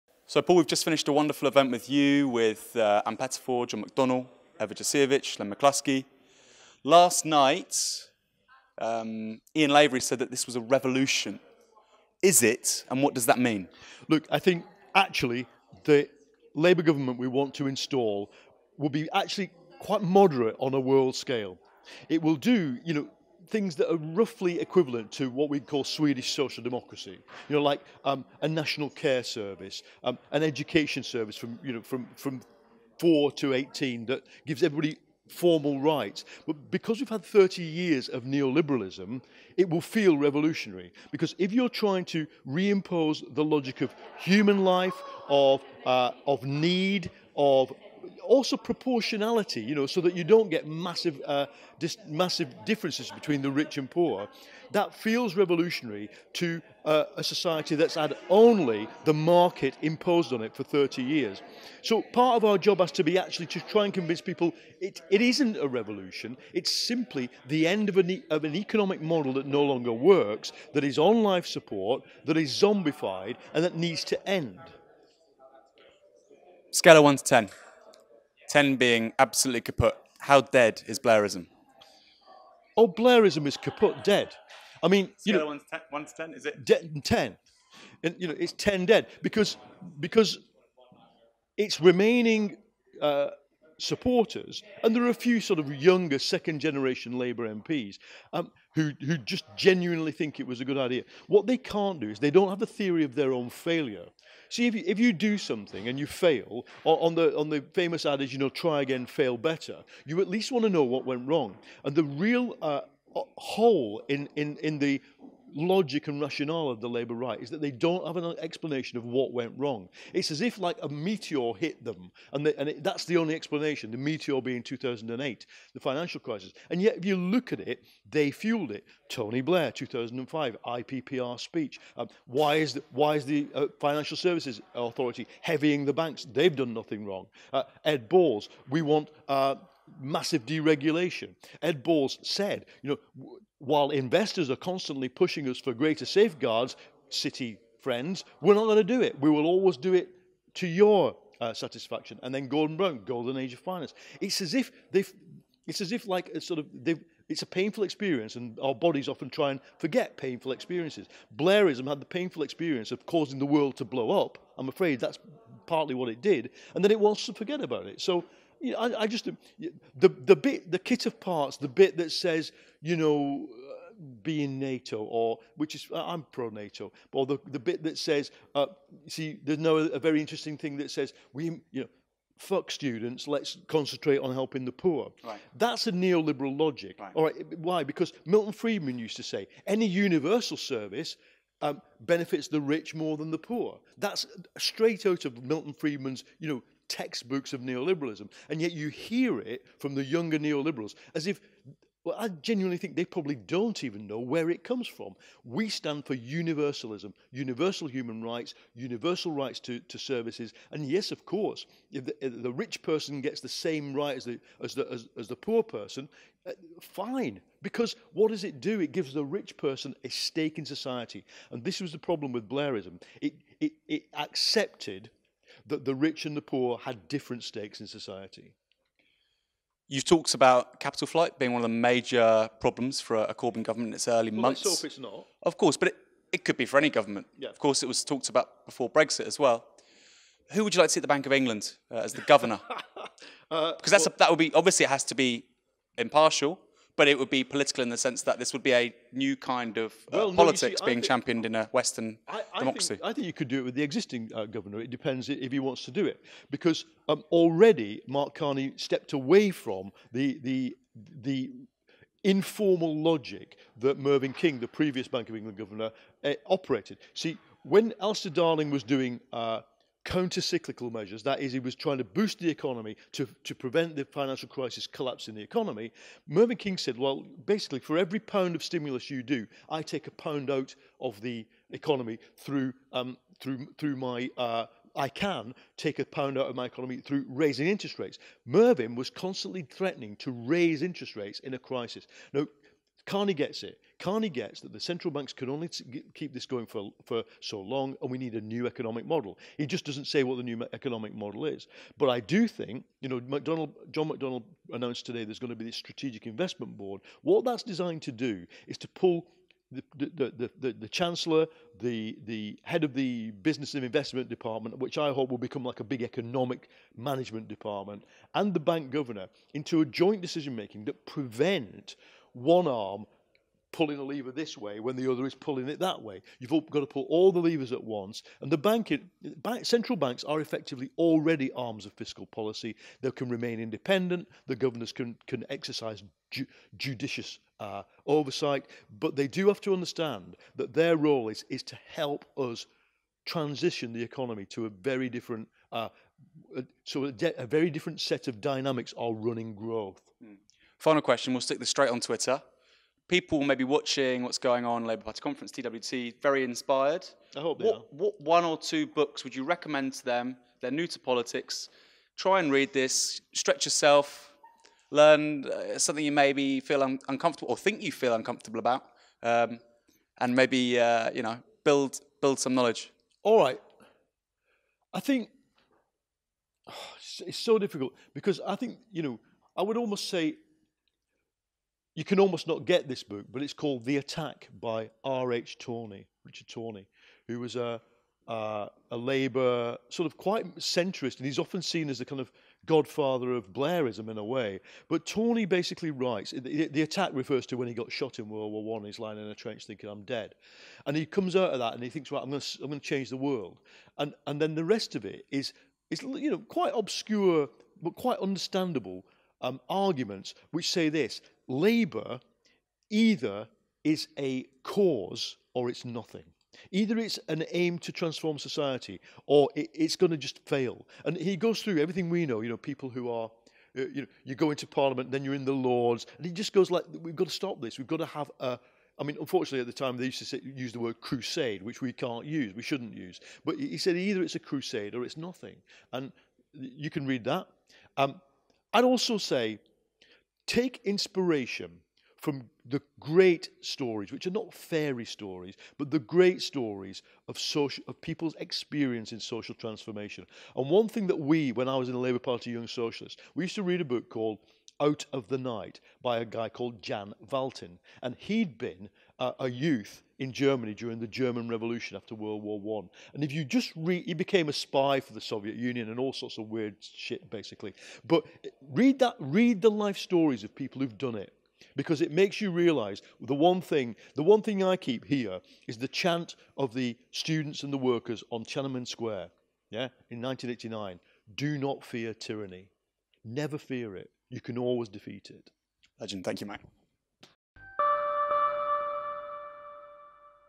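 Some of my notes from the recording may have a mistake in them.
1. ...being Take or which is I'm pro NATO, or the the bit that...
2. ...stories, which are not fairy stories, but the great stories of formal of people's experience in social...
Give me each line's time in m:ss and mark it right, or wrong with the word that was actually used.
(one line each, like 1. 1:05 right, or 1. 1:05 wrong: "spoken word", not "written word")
1. 2:54 wrong: "NATO", not "Take"
2. 7:23 wrong: "social", not "formal".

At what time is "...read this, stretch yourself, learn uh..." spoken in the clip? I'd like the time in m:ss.
6:02.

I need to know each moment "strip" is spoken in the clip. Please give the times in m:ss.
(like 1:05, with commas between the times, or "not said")
not said.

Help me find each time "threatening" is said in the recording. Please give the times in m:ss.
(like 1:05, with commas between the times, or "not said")
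4:49.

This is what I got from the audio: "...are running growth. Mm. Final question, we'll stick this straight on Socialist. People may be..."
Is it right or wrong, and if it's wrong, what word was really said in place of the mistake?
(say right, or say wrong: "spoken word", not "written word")
wrong: "Twitter", not "Socialist".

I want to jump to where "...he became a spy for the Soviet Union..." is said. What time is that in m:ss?
7:44.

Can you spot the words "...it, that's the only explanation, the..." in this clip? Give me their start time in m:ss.
2:02.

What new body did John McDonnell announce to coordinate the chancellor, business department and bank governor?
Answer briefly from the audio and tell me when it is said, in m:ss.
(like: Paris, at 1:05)
strategic investment board, at 5:05.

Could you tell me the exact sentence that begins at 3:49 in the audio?
You've talked about capital flight being one of the major problems for a Corbyn government in its early well, months.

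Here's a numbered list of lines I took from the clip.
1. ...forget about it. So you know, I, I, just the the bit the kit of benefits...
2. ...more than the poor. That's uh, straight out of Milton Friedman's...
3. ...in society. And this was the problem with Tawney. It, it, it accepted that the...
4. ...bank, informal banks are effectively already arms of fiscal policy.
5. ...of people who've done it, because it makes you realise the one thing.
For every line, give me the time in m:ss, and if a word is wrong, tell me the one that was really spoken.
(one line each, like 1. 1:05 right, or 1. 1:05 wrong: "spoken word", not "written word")
1. 2:47 wrong: "parts", not "benefits"
2. 3:12 right
3. 3:40 wrong: "Blairism", not "Tawney"
4. 5:29 wrong: "central", not "informal"
5. 7:50 right.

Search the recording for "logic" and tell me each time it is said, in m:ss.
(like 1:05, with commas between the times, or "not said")
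0:43, 1:55, 3:06, 4:23.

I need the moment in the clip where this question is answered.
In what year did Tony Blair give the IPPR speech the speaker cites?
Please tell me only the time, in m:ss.
2:09.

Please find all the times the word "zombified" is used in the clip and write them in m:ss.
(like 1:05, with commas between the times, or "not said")
1:12.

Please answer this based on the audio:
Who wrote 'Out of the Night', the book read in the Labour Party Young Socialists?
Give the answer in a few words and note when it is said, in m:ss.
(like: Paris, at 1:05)
Jan Valtin, at 7:36.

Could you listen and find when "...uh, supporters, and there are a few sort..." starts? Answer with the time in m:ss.
1:33.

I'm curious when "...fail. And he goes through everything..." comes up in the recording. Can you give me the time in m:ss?
7:00.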